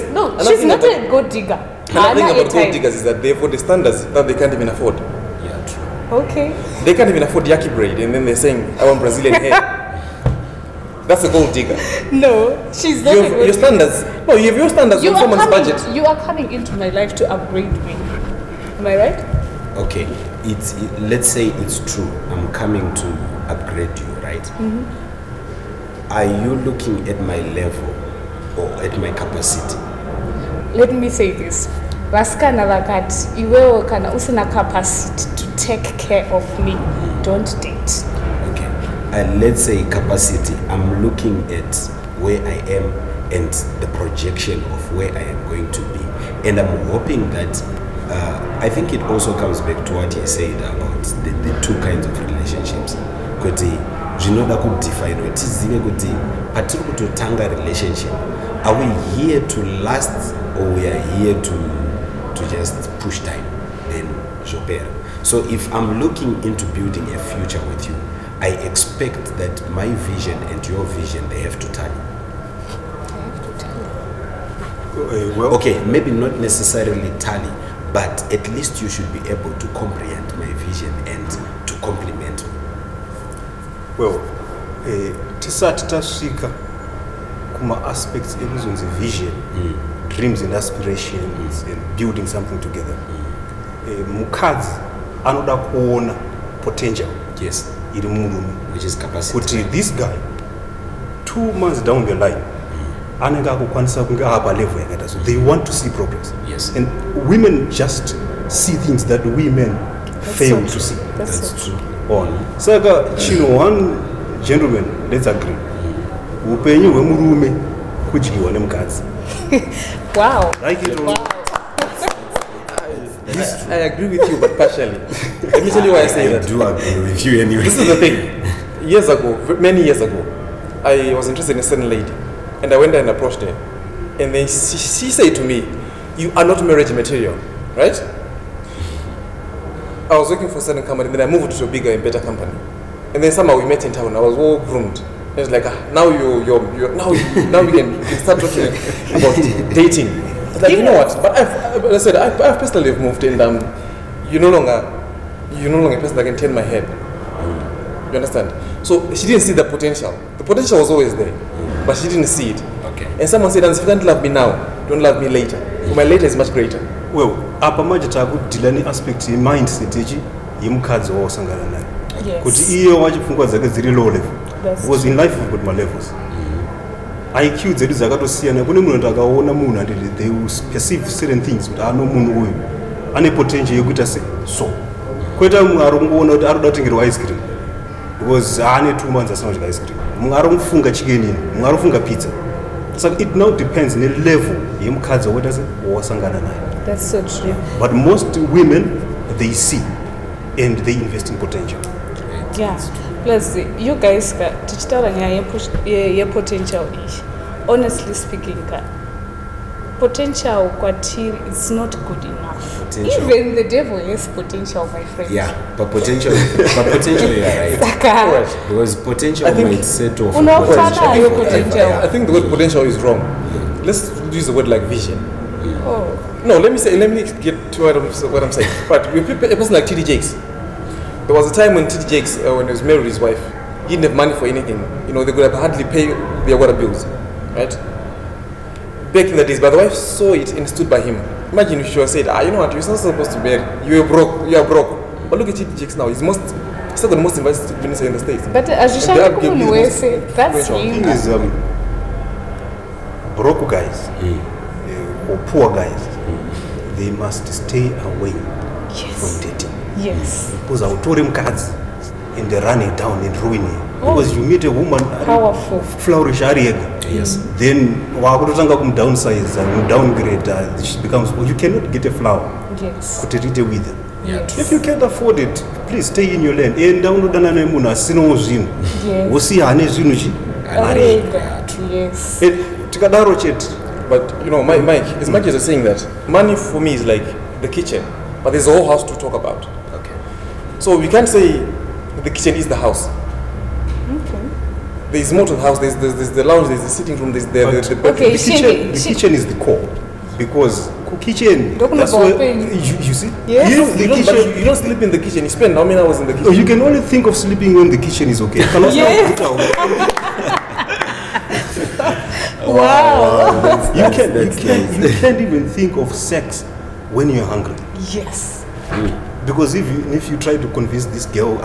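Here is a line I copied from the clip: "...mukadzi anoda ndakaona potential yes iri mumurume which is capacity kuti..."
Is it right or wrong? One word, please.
wrong.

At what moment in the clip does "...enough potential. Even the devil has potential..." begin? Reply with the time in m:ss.
3:32.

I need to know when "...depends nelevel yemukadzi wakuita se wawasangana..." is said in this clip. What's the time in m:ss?
3:13.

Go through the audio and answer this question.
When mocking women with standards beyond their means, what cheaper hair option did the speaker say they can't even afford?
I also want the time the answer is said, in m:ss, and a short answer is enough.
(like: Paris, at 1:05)
yaki braid, at 0:07.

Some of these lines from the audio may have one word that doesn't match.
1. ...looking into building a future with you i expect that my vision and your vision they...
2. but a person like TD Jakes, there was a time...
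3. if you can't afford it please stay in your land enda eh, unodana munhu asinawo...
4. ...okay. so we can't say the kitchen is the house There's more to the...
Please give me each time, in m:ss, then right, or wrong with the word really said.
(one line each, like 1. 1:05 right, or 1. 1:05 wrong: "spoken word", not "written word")
1. 1:06 right
2. 3:48 right
3. 4:34 wrong: "nemunhu", not "munhu"
4. 4:49 right.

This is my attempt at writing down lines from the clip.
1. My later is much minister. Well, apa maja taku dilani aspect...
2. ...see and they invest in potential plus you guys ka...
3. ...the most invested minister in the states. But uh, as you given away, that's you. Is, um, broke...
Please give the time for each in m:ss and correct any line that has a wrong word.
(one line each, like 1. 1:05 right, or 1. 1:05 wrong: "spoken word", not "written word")
1. 2:45 wrong: "greater", not "minister"
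2. 3:19 right
3. 4:07 right.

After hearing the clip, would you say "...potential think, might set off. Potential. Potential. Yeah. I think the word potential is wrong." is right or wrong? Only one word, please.
right.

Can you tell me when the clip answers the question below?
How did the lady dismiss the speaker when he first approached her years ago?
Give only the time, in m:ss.
2:16.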